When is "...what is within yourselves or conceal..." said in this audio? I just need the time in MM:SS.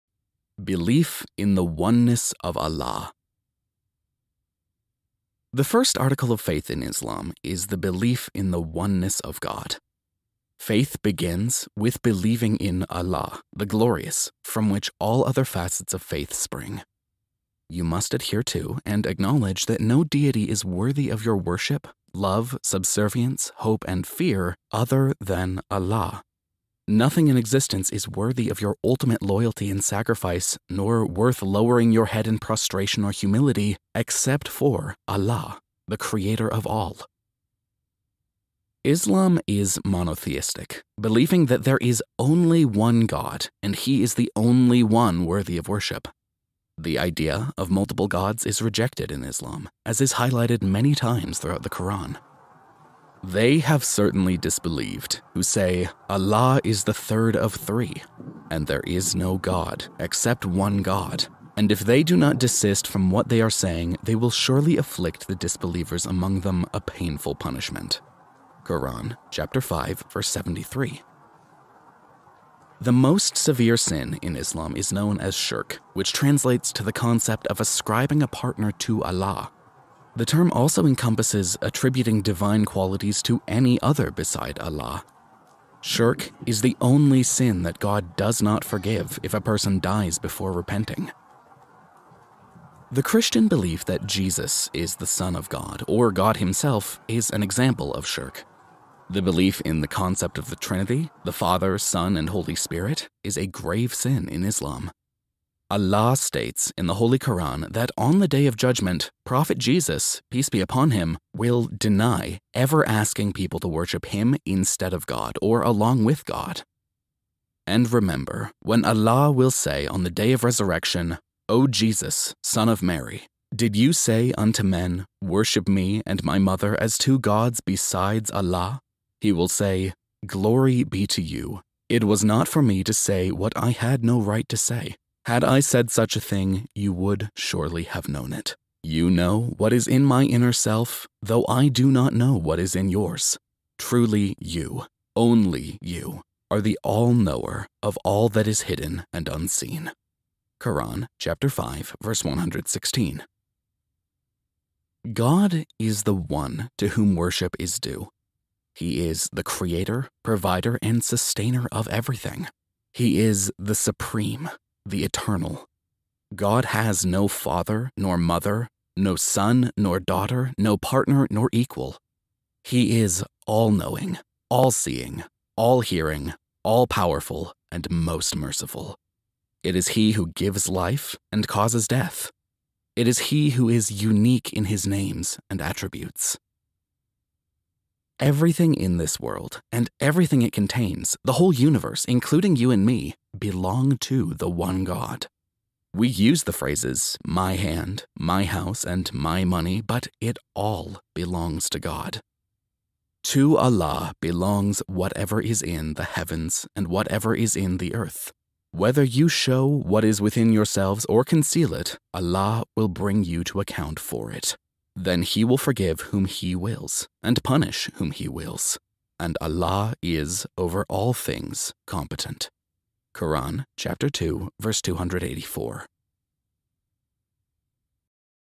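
03:29.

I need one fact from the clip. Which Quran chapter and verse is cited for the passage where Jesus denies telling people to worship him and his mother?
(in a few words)
Chapter 5 verse 116.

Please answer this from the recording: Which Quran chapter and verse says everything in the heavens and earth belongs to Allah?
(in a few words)
Chapter 2 verse 284.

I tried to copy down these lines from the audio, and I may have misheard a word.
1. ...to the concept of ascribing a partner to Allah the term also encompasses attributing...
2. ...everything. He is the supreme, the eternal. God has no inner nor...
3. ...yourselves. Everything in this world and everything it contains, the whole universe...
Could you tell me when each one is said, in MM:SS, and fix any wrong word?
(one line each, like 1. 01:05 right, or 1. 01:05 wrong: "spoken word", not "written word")
1. 01:16 right
2. 02:41 wrong: "father", not "inner"
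3. 03:05 wrong: "attributes", not "yourselves".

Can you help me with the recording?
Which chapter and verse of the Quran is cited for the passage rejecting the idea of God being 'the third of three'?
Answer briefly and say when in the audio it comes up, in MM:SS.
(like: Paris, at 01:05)
Chapter 5 verse 73, at 01:09.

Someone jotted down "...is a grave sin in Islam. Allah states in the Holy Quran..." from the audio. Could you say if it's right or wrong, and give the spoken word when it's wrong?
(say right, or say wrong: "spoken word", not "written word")
right.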